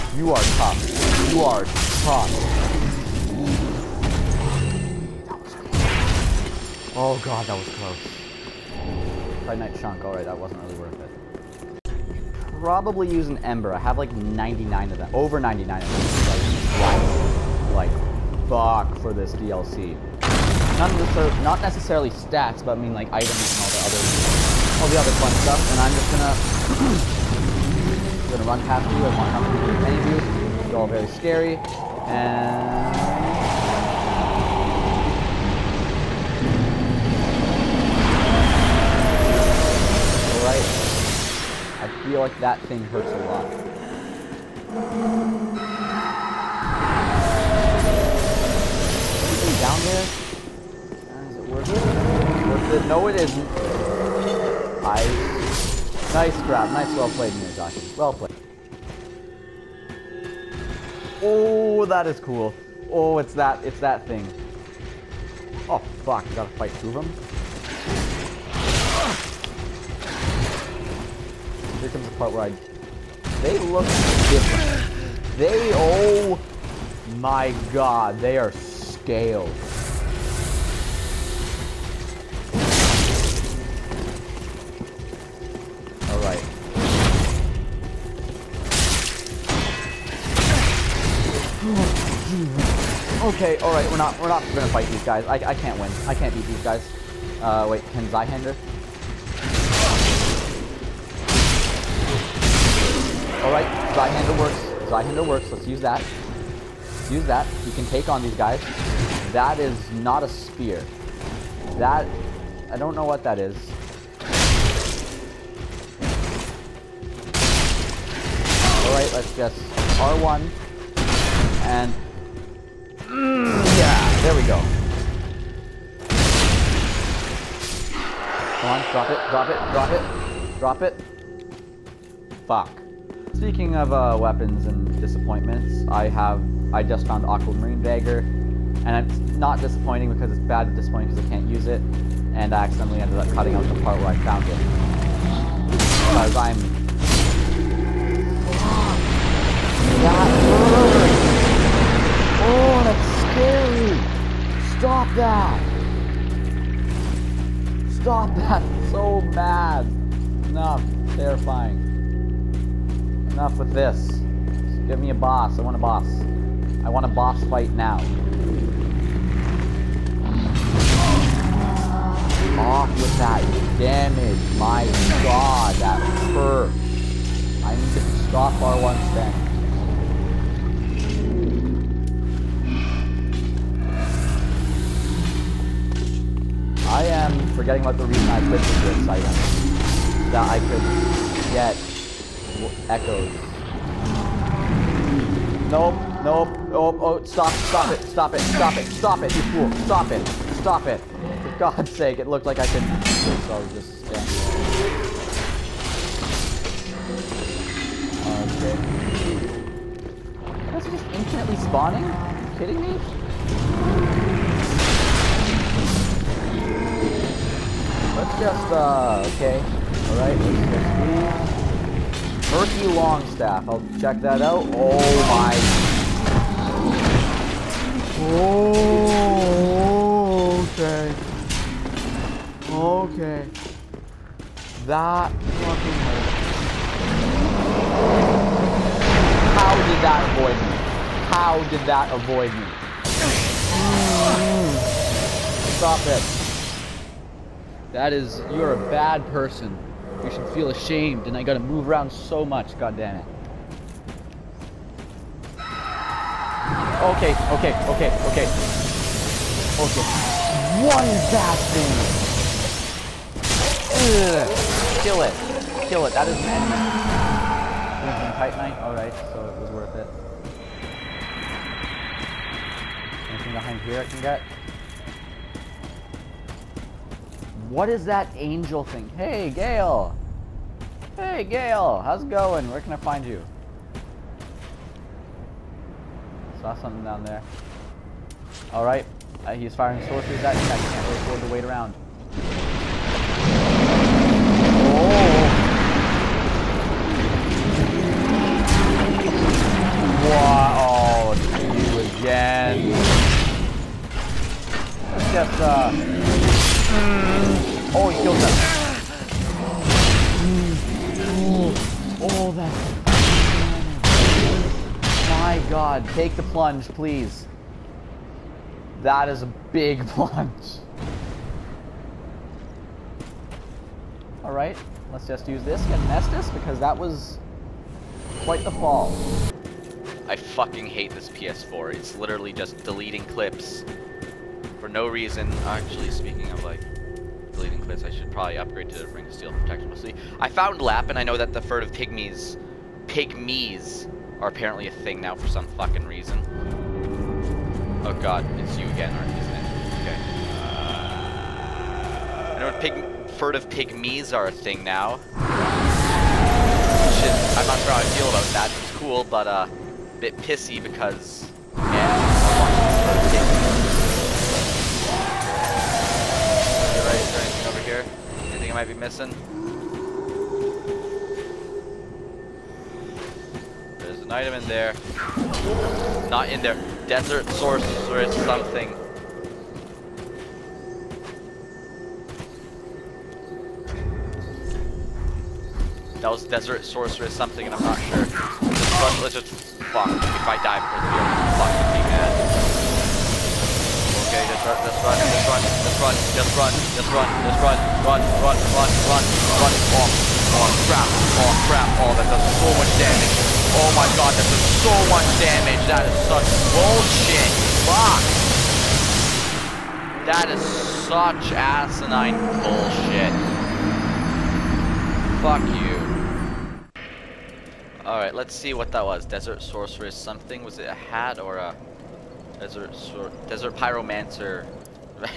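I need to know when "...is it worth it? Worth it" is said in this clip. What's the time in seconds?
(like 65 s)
51 s.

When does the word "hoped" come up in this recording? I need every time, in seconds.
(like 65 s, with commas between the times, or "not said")
not said.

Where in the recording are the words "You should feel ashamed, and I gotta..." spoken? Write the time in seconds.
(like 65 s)
250 s.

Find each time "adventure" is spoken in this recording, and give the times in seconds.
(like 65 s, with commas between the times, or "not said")
not said.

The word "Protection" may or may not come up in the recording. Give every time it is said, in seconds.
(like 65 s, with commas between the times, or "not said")
339 s.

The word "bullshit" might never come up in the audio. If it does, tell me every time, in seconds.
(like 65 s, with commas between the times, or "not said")
406 s, 412 s.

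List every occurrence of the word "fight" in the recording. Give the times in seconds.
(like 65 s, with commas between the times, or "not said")
66 s, 94 s, 167 s.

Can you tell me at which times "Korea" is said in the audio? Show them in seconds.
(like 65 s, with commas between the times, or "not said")
not said.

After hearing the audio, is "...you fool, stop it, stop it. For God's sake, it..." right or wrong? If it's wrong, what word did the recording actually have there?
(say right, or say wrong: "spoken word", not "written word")
right.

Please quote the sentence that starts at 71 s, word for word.
Here comes the part where I...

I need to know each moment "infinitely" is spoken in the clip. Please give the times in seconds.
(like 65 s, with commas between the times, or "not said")
211 s.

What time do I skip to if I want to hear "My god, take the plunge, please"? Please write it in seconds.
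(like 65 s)
315 s.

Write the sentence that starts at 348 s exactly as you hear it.
Oh god, it's you again, aren't isn't it?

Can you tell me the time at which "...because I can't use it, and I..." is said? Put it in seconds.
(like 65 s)
141 s.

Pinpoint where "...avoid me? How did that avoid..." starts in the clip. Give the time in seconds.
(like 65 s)
240 s.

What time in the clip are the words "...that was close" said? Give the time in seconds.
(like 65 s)
7 s.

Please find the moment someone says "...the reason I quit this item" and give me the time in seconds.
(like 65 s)
187 s.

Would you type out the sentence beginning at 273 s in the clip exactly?
Anything behind here I can get?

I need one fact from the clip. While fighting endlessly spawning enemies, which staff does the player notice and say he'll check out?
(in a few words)
Murky Longstaff.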